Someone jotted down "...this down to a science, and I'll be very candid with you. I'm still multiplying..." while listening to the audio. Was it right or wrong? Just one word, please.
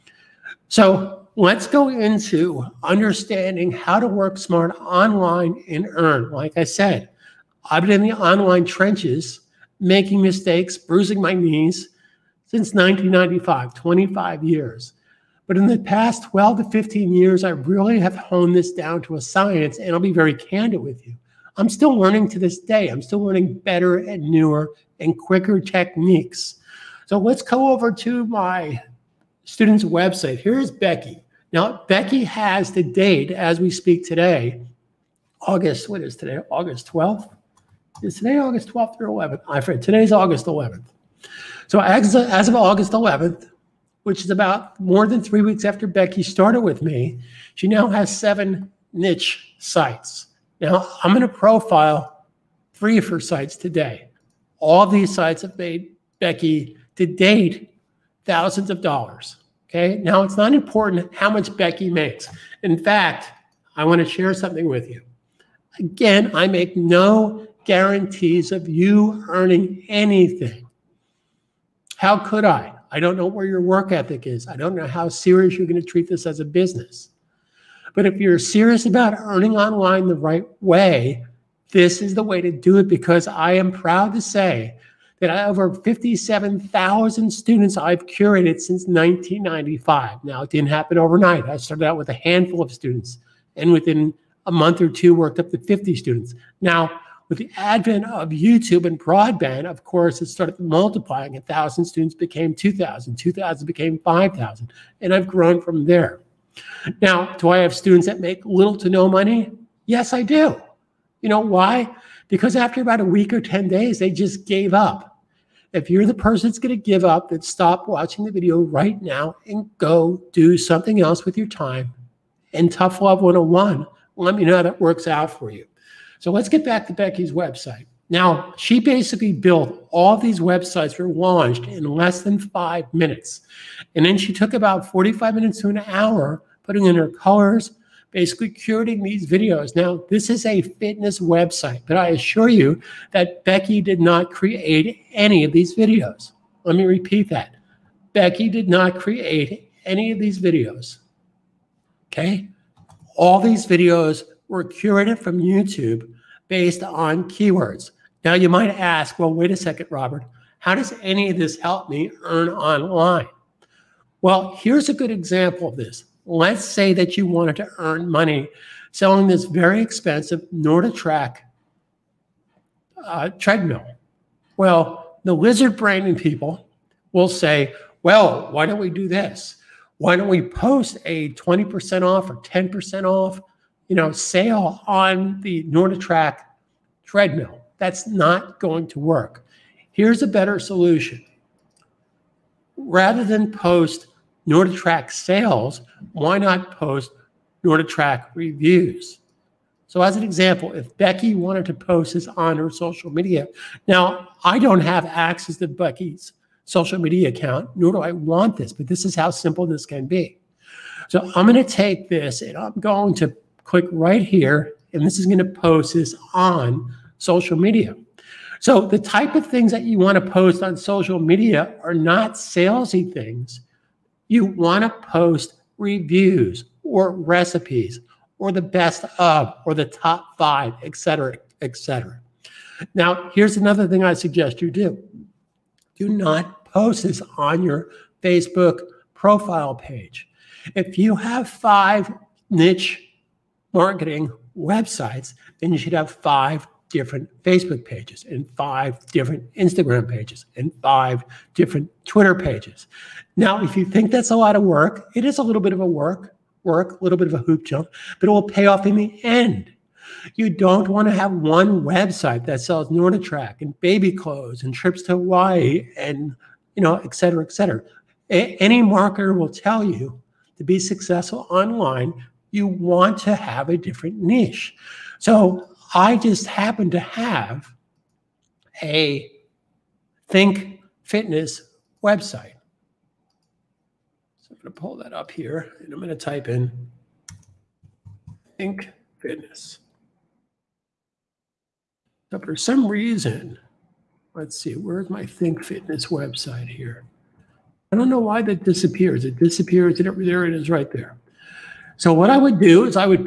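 wrong.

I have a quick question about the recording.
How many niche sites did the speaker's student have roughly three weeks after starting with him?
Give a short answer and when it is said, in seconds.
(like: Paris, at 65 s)
7, at 48 s.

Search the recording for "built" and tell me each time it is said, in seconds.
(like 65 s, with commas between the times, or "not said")
129 s.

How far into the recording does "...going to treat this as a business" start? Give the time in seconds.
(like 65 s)
75 s.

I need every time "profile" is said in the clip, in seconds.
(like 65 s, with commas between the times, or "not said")
51 s, 239 s.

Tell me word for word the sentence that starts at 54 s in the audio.
All of these sites have made Becky to date thousands of dollars.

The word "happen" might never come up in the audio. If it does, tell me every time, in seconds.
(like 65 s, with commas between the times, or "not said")
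90 s, 276 s.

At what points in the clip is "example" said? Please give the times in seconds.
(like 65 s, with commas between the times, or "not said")
165 s, 200 s.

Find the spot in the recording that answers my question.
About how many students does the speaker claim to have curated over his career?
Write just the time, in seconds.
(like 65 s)
85 s.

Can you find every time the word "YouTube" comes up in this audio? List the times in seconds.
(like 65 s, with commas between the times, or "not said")
98 s, 155 s.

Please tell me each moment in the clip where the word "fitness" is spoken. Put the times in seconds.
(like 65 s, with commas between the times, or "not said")
140 s, 281 s, 289 s, 295 s.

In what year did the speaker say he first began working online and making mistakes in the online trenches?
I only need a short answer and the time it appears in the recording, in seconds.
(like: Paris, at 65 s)
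1995, at 12 s.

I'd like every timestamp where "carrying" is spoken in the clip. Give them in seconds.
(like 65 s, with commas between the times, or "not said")
not said.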